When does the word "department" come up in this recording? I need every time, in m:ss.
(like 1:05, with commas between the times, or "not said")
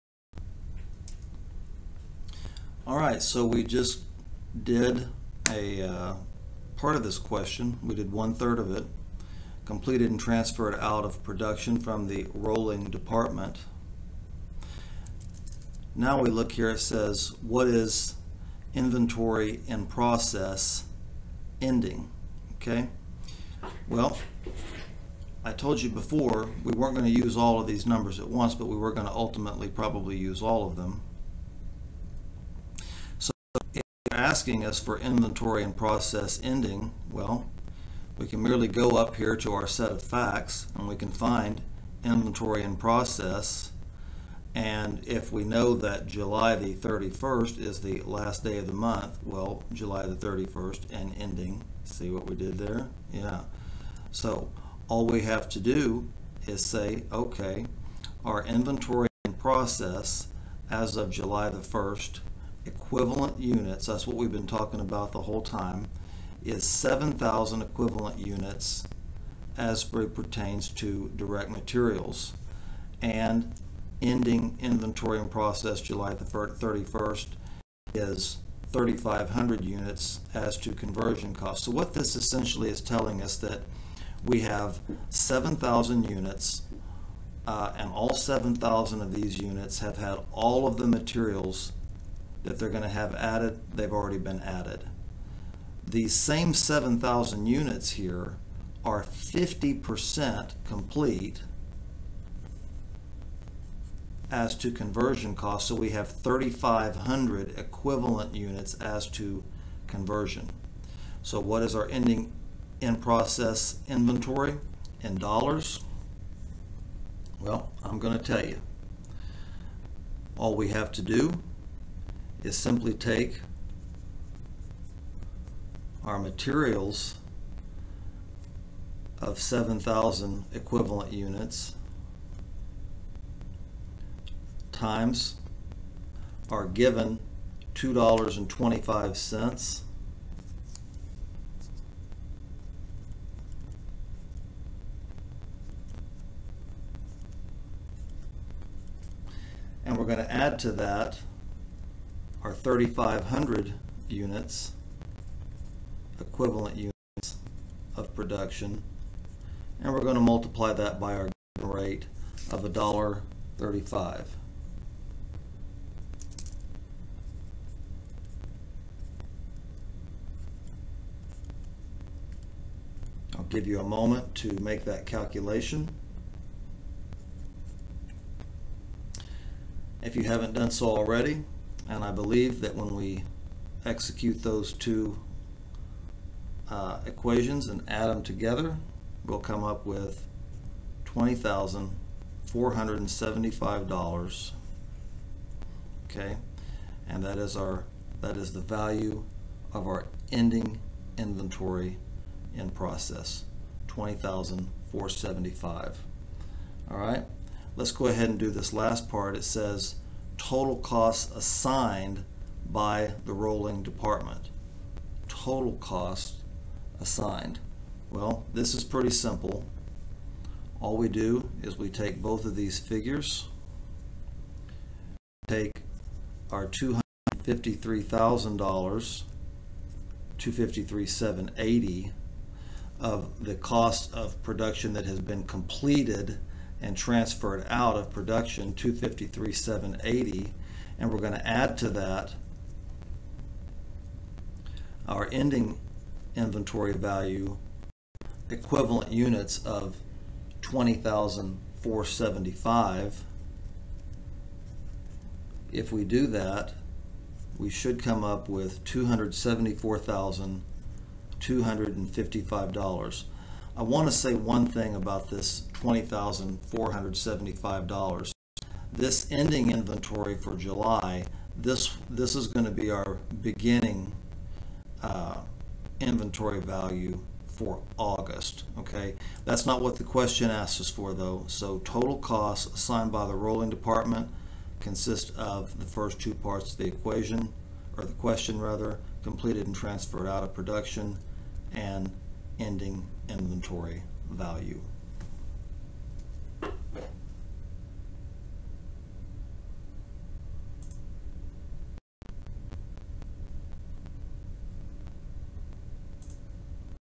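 0:12, 3:33, 4:43.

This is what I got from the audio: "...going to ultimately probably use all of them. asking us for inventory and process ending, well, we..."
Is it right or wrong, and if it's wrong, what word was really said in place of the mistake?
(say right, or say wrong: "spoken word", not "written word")
right.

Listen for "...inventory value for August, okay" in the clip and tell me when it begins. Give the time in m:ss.
4:36.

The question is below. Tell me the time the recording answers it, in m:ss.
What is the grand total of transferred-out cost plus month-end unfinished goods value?
4:18.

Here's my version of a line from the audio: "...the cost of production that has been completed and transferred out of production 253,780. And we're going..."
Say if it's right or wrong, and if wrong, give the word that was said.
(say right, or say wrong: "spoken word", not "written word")
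right.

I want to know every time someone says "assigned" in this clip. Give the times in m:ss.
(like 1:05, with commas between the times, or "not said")
3:31, 3:36, 4:42.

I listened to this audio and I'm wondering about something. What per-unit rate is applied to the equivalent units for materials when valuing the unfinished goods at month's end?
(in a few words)
$2.25.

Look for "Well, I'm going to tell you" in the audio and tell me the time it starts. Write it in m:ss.
1:57.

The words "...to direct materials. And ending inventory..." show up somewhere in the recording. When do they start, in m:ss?
1:10.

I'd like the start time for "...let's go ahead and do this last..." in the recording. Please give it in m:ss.
3:27.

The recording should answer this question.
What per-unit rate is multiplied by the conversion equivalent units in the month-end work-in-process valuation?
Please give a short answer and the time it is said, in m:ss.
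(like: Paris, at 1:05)
$1.35, at 2:42.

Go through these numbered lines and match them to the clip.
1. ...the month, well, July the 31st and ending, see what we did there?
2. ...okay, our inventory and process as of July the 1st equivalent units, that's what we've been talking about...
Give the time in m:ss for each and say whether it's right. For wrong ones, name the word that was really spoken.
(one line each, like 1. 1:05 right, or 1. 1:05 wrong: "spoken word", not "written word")
1. 0:48 right
2. 0:57 right.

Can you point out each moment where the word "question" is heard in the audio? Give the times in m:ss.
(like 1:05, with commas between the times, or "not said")
0:07, 4:40, 4:48.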